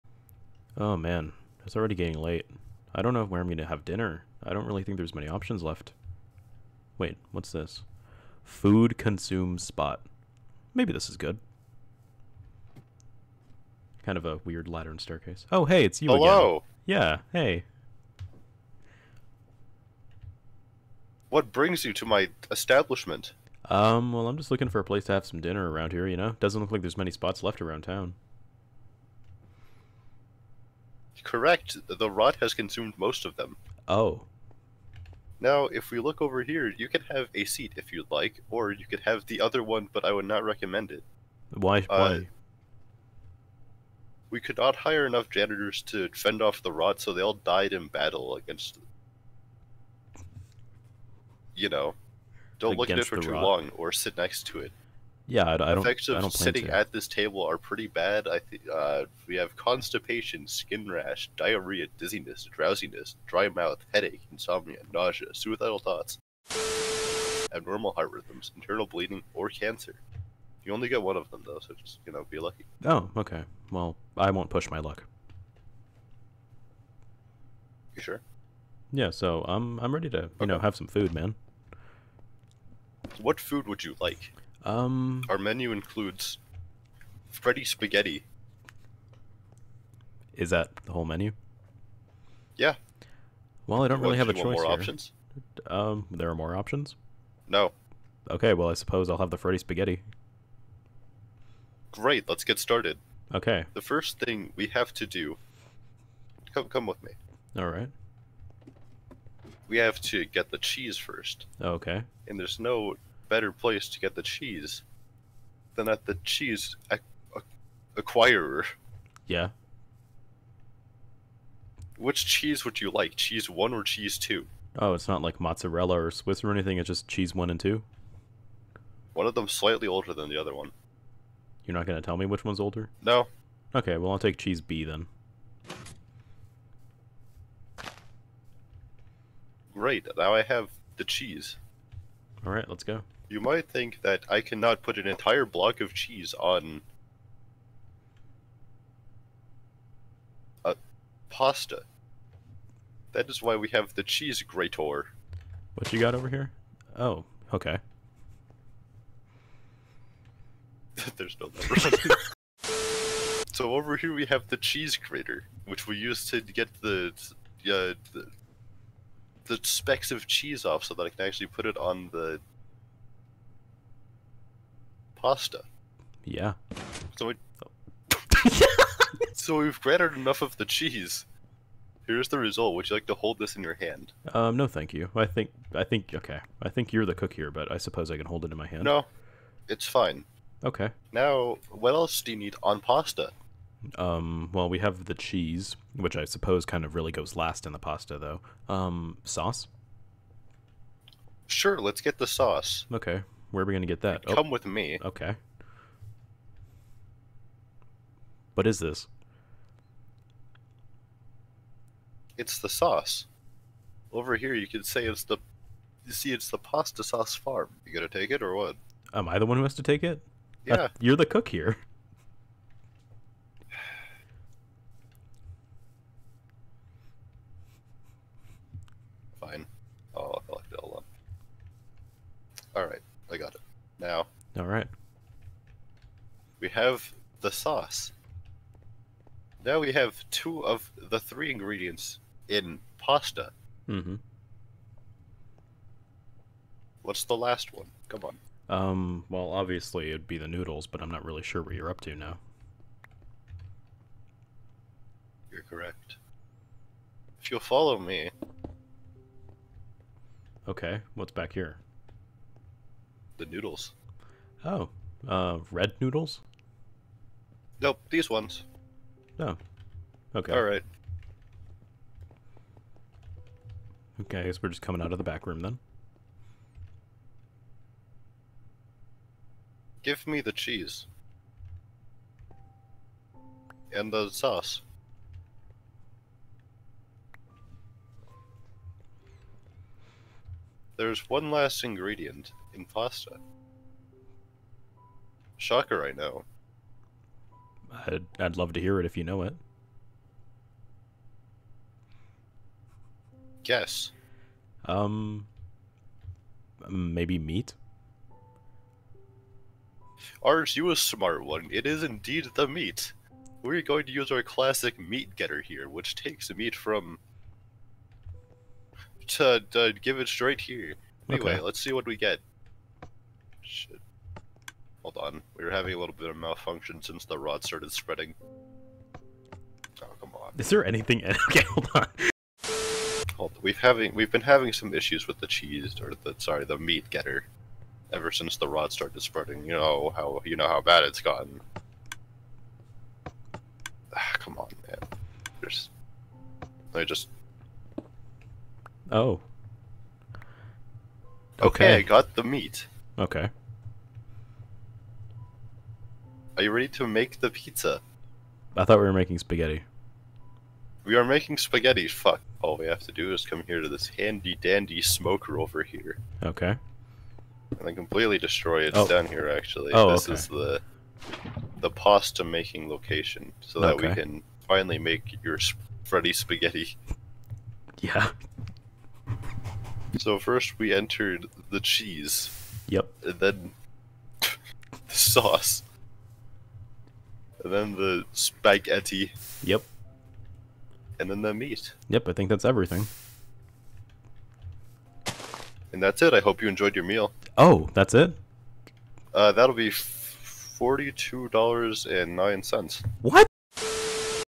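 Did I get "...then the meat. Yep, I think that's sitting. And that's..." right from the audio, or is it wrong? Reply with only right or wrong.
wrong.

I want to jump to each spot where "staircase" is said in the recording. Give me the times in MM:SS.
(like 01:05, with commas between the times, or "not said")
00:14.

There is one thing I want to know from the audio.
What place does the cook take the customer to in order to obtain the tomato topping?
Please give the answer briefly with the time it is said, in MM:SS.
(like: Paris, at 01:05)
Pasta sauce farm, at 03:36.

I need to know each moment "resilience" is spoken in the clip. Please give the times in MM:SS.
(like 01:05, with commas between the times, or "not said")
not said.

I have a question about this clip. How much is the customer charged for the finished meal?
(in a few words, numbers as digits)
$42.09.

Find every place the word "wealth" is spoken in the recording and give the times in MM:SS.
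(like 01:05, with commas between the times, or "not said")
not said.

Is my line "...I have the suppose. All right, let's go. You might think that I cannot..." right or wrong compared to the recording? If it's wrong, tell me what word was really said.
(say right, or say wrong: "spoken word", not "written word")
wrong: "cheese", not "suppose".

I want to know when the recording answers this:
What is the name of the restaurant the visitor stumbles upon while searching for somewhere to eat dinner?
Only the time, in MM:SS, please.
00:08.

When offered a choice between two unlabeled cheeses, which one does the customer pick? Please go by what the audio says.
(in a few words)
Cheese B.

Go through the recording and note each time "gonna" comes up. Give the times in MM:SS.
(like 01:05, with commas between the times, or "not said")
02:11, 03:37.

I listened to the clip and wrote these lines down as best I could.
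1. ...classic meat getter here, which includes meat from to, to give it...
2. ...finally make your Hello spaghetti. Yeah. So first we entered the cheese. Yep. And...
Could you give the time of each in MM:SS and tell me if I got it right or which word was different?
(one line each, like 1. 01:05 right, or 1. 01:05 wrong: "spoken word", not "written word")
1. 05:14 wrong: "takes", not "includes"
2. 06:14 wrong: "Freddy", not "Hello".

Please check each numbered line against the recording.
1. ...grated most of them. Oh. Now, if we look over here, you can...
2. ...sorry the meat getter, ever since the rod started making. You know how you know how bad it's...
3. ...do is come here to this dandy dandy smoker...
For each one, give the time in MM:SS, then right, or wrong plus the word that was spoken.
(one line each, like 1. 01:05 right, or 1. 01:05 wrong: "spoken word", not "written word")
1. 00:32 wrong: "consumed", not "grated"
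2. 05:36 wrong: "spreading", not "making"
3. 06:03 wrong: "handy", not "dandy".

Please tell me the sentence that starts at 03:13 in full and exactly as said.
Um, well, we have the cheese, which I suppose kind of really goes last in the pasta, though.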